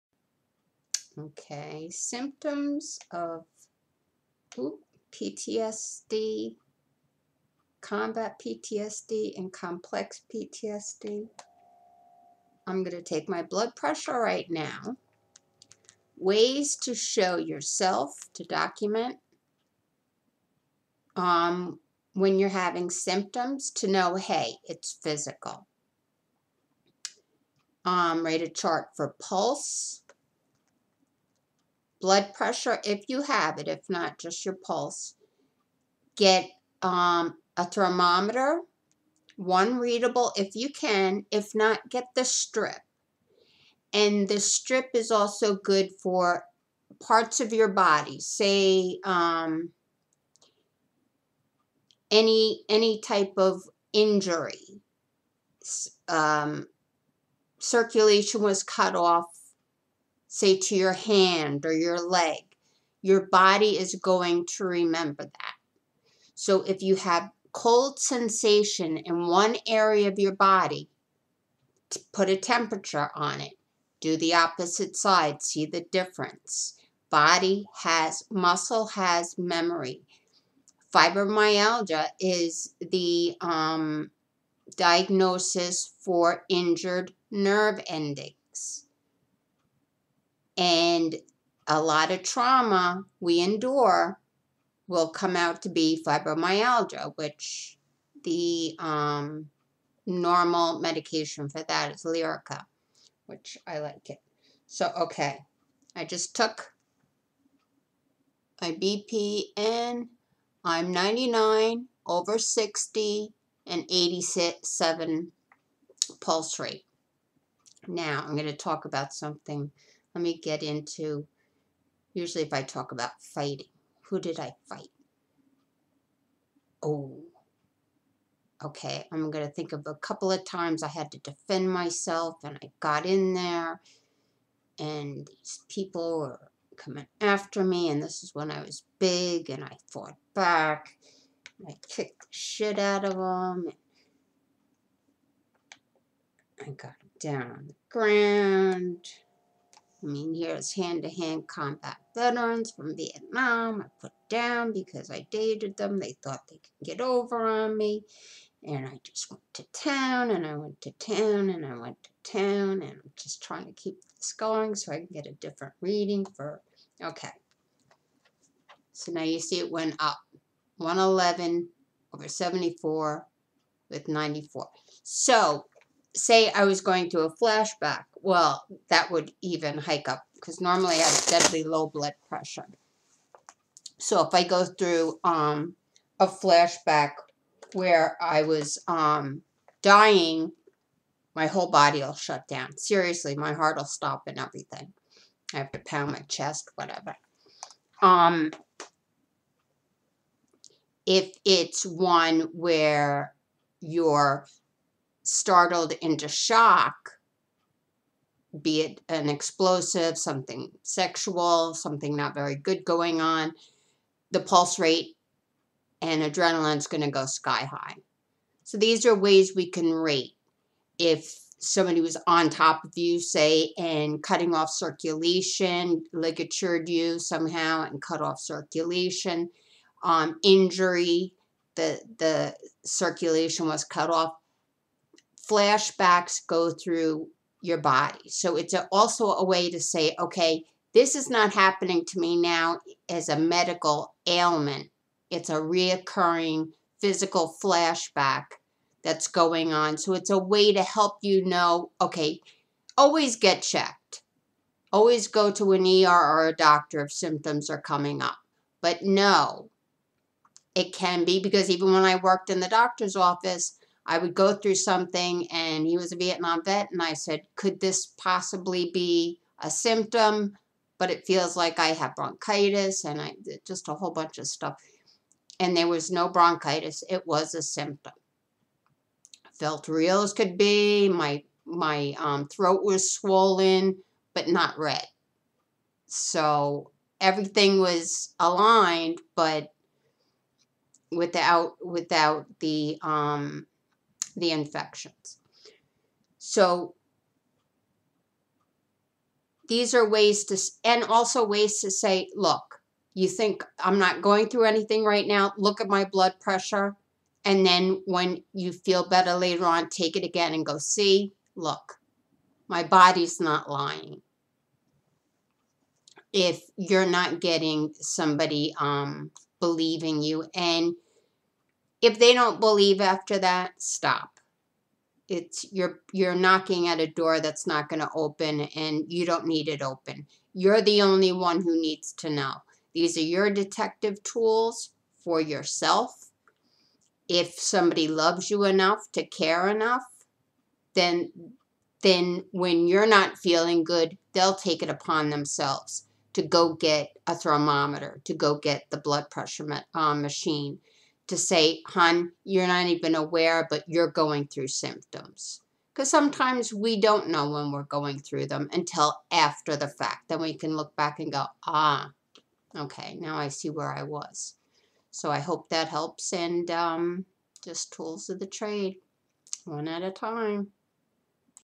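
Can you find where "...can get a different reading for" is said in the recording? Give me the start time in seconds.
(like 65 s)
164 s.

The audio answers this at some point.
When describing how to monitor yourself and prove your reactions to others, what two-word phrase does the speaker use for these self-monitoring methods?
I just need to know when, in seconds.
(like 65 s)
333 s.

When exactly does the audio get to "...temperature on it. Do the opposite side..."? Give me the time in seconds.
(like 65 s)
72 s.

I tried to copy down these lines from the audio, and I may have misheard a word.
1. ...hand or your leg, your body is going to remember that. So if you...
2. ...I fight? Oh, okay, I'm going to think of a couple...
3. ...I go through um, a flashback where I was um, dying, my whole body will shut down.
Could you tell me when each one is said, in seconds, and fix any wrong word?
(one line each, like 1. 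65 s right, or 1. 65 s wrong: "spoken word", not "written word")
1. 60 s right
2. 124 s right
3. 184 s right.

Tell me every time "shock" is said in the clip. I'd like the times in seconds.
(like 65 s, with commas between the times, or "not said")
206 s.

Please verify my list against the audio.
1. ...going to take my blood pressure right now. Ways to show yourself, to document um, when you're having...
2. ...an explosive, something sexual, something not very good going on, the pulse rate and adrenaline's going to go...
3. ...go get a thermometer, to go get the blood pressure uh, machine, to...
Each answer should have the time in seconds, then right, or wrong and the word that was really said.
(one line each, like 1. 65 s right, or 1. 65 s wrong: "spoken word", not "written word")
1. 12 s right
2. 209 s right
3. 346 s right.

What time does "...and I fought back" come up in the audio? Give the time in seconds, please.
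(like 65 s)
139 s.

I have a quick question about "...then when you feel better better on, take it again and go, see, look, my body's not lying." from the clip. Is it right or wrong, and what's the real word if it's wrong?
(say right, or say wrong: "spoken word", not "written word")
wrong: "later", not "better".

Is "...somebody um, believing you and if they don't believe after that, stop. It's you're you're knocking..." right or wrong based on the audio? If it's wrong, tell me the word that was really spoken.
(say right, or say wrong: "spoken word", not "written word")
right.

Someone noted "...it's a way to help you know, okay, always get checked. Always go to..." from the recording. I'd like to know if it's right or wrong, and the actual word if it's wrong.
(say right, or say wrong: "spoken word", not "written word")
right.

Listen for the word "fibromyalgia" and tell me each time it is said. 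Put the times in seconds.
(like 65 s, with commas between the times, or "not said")
80 s, 96 s.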